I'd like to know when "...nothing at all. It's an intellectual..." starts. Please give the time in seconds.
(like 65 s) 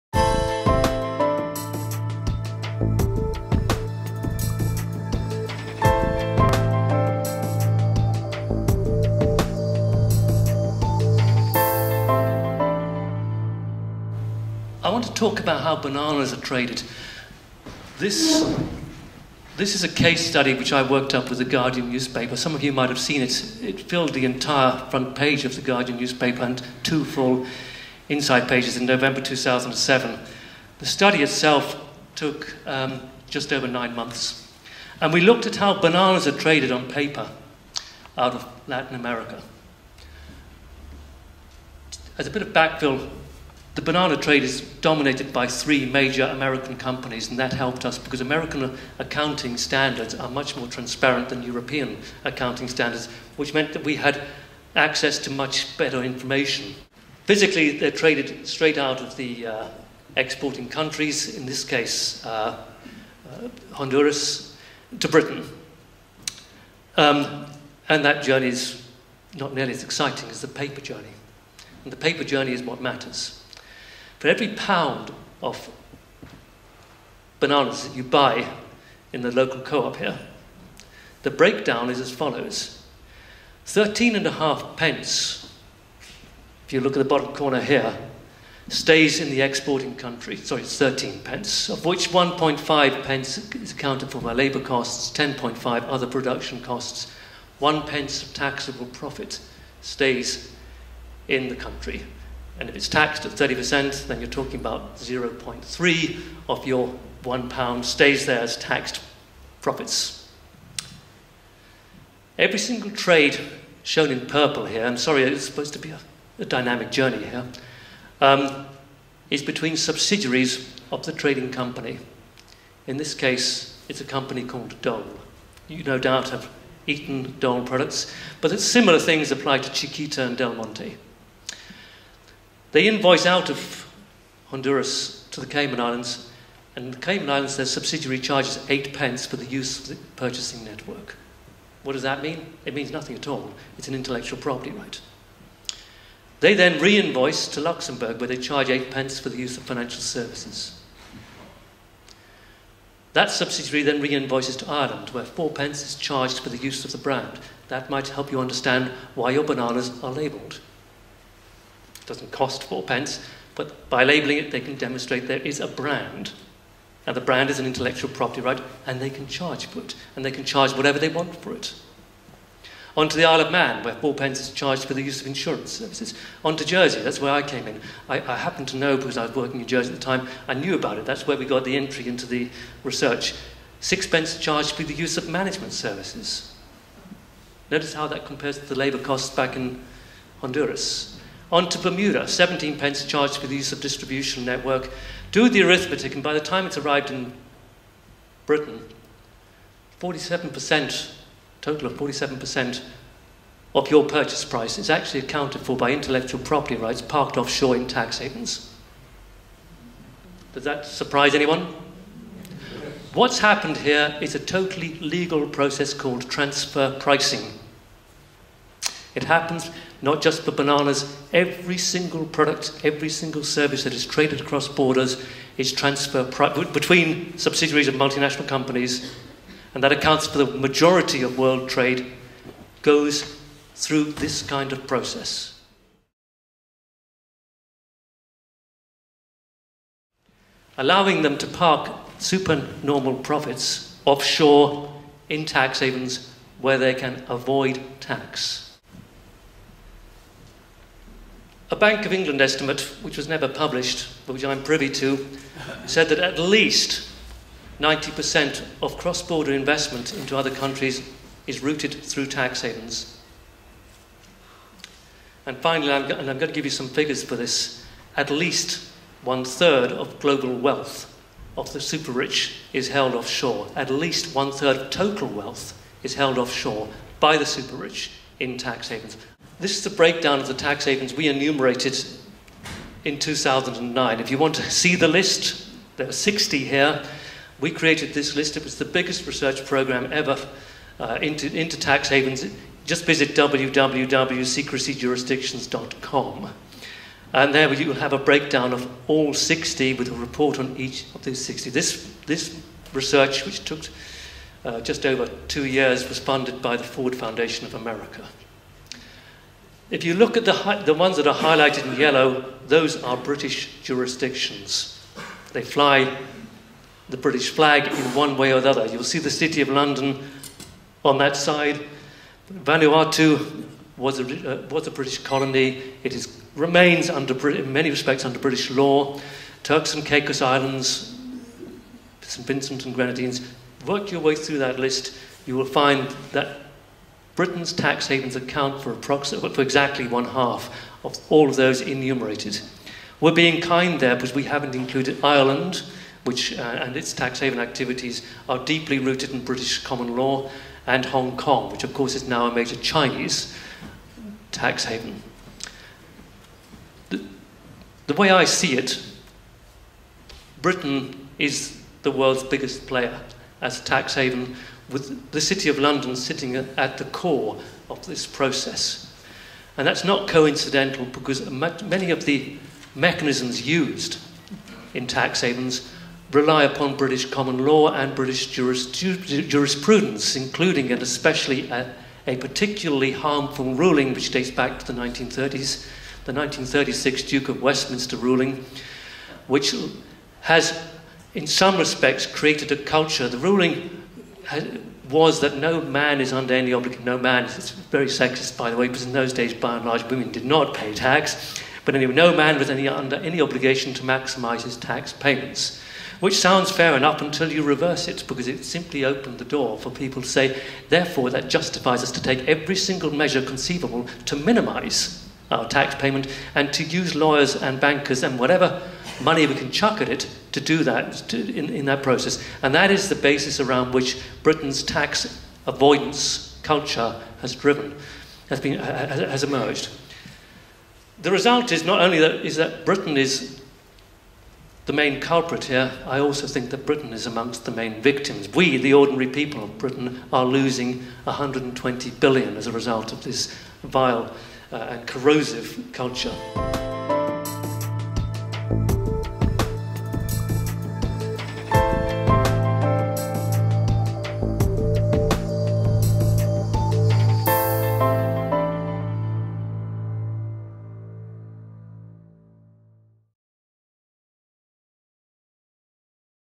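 142 s.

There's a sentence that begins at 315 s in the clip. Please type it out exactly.
They fly the British flag in one way or the other.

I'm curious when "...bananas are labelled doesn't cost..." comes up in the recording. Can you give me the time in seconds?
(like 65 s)
159 s.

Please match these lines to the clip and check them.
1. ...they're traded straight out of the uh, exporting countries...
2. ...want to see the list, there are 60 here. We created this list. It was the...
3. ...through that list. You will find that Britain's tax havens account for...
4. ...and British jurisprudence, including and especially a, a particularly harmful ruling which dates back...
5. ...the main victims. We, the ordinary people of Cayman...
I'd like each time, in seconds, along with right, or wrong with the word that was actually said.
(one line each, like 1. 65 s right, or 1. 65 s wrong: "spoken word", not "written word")
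1. 57 s right
2. 284 s right
3. 334 s right
4. 377 s right
5. 437 s wrong: "Britain", not "Cayman".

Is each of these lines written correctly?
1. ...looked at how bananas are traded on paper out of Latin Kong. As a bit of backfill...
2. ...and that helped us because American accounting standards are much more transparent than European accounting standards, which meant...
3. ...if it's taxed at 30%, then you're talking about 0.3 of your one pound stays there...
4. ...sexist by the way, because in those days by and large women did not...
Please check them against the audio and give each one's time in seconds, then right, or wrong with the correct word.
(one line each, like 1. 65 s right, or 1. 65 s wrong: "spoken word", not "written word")
1. 35 s wrong: "America", not "Kong"
2. 47 s right
3. 102 s right
4. 398 s right.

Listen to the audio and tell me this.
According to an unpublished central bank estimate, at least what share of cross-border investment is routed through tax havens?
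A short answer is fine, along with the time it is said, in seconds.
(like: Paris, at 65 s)
90%, at 257 s.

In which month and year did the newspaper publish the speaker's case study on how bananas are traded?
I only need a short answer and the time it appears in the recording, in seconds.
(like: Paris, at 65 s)
November 2007, at 28 s.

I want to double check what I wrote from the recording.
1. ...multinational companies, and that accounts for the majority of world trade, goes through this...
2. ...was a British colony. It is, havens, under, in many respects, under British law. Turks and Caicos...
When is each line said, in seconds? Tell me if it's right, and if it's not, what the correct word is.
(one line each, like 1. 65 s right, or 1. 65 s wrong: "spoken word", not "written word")
1. 227 s right
2. 324 s wrong: "remains", not "havens".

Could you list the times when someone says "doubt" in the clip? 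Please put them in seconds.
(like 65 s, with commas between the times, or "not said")
125 s.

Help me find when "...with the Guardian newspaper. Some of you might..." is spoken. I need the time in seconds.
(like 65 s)
21 s.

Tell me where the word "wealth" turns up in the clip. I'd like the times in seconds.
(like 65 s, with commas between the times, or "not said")
270 s, 275 s.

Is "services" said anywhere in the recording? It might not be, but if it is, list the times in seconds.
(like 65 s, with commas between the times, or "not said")
150 s, 175 s, 185 s, 223 s.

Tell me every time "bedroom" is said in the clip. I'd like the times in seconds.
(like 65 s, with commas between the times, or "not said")
not said.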